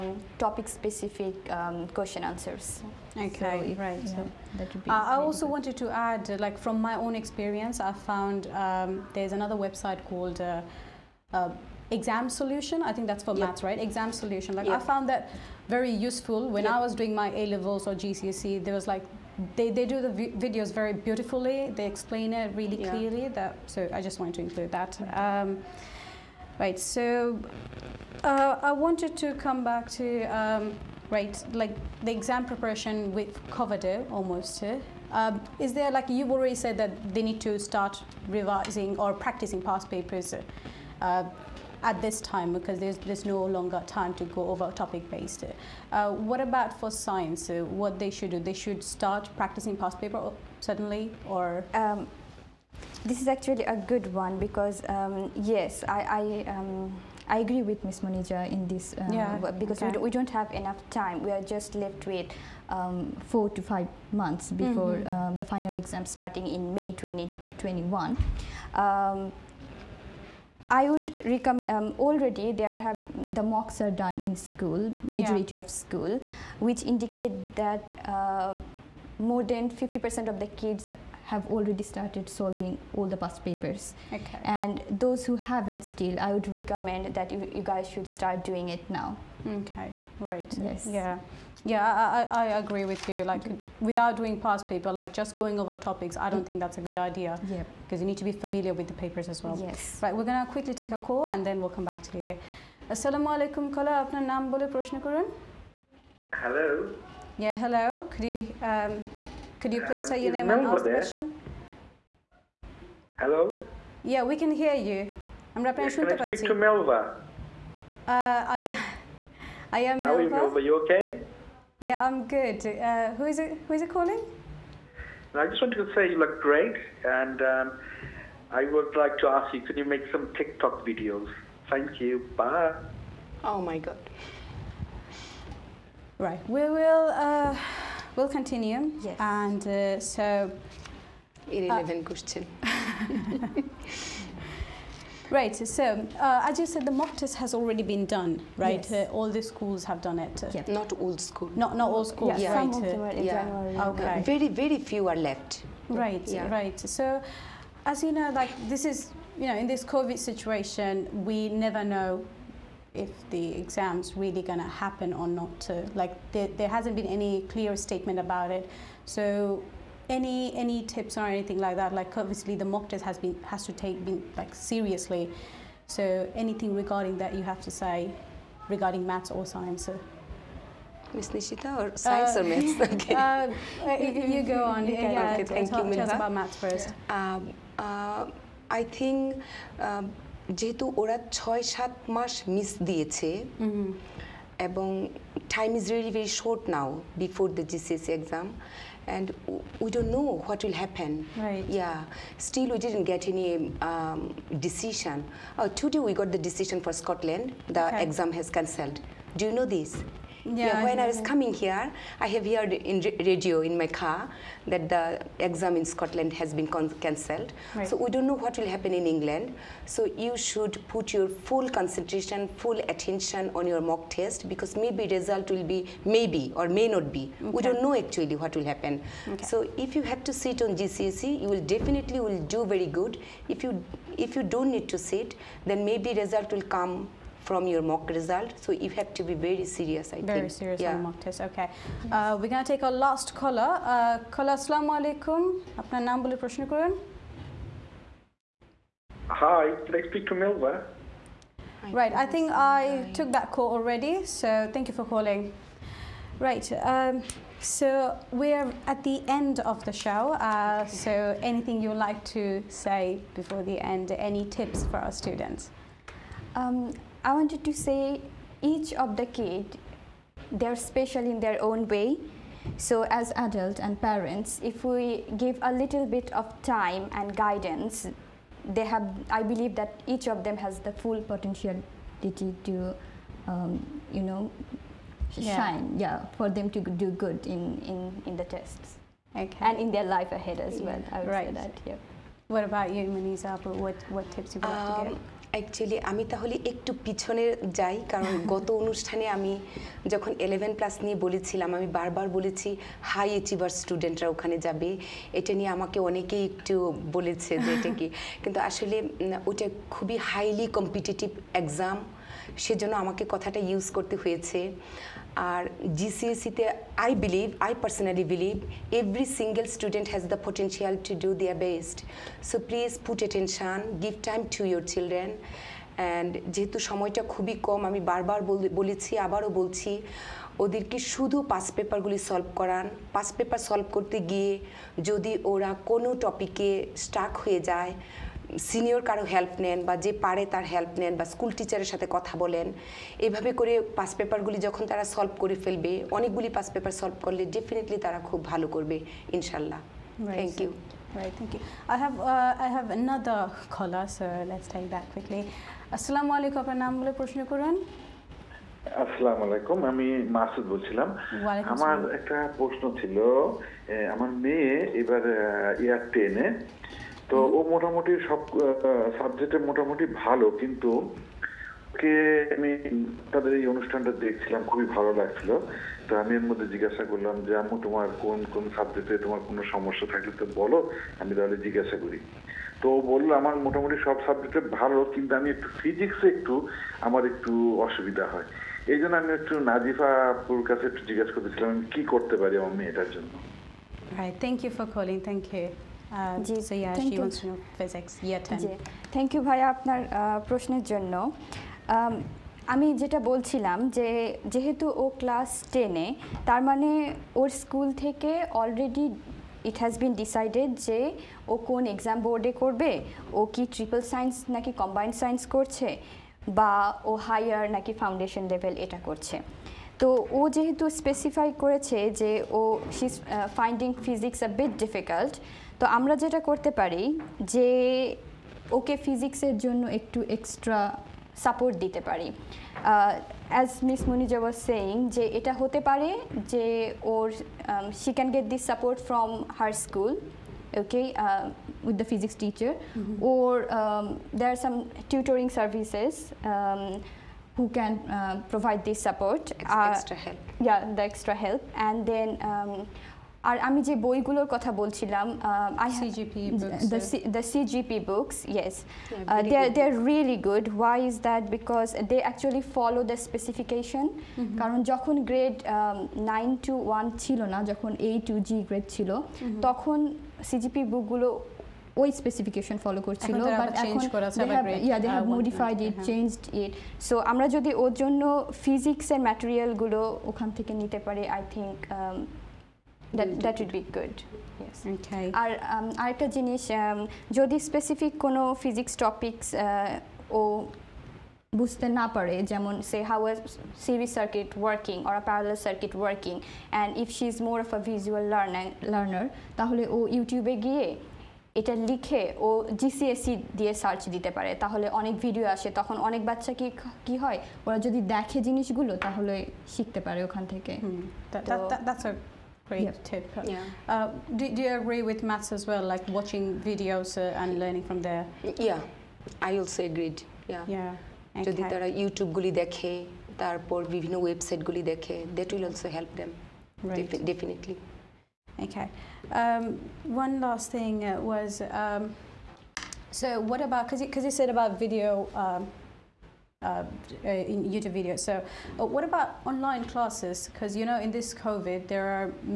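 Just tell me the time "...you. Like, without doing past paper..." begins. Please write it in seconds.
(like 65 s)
93 s.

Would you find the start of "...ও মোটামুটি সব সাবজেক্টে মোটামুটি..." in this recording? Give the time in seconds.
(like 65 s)
367 s.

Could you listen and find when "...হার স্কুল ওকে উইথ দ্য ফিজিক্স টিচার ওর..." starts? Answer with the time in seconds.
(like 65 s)
439 s.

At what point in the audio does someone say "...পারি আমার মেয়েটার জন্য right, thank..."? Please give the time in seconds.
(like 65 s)
392 s.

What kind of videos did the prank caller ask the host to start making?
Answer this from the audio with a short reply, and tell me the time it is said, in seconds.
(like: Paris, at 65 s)
TikTok, at 130 s.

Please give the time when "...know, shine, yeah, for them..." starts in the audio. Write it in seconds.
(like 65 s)
284 s.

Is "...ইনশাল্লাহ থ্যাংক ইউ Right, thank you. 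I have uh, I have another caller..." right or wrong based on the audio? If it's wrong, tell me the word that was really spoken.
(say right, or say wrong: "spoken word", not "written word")
right.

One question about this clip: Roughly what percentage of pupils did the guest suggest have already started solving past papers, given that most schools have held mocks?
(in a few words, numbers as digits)
50%.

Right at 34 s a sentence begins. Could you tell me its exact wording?
Uh, um, is there like you've already said that they need to start revising or practicing past papers?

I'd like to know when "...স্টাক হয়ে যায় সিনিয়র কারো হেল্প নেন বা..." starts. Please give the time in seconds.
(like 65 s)
337 s.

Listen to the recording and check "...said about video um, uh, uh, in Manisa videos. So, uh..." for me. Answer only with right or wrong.
wrong.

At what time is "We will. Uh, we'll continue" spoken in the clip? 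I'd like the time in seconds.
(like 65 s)
136 s.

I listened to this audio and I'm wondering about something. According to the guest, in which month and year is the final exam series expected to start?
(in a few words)
May 2021.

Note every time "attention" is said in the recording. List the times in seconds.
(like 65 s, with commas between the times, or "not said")
222 s.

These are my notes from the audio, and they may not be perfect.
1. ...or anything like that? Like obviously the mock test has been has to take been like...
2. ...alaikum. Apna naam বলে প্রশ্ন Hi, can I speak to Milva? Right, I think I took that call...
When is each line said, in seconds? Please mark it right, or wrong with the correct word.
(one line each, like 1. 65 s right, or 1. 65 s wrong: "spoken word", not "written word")
1. 171 s right
2. 244 s right.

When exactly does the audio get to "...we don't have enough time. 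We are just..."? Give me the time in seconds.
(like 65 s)
60 s.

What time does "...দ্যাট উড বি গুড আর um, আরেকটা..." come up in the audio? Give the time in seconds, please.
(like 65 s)
483 s.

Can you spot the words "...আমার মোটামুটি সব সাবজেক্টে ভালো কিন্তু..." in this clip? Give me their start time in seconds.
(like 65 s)
383 s.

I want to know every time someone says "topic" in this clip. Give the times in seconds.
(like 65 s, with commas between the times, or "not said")
0 s, 44 s, 95 s.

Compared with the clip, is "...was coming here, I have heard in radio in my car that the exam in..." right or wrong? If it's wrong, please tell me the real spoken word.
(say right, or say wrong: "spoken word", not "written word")
right.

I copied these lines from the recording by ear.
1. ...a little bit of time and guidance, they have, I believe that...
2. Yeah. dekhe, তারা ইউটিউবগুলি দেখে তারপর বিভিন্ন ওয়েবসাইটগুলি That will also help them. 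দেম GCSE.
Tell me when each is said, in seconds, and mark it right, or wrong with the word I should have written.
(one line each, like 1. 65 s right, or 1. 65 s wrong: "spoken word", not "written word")
1. 275 s right
2. 520 s wrong: "Definitely", not "GCSE".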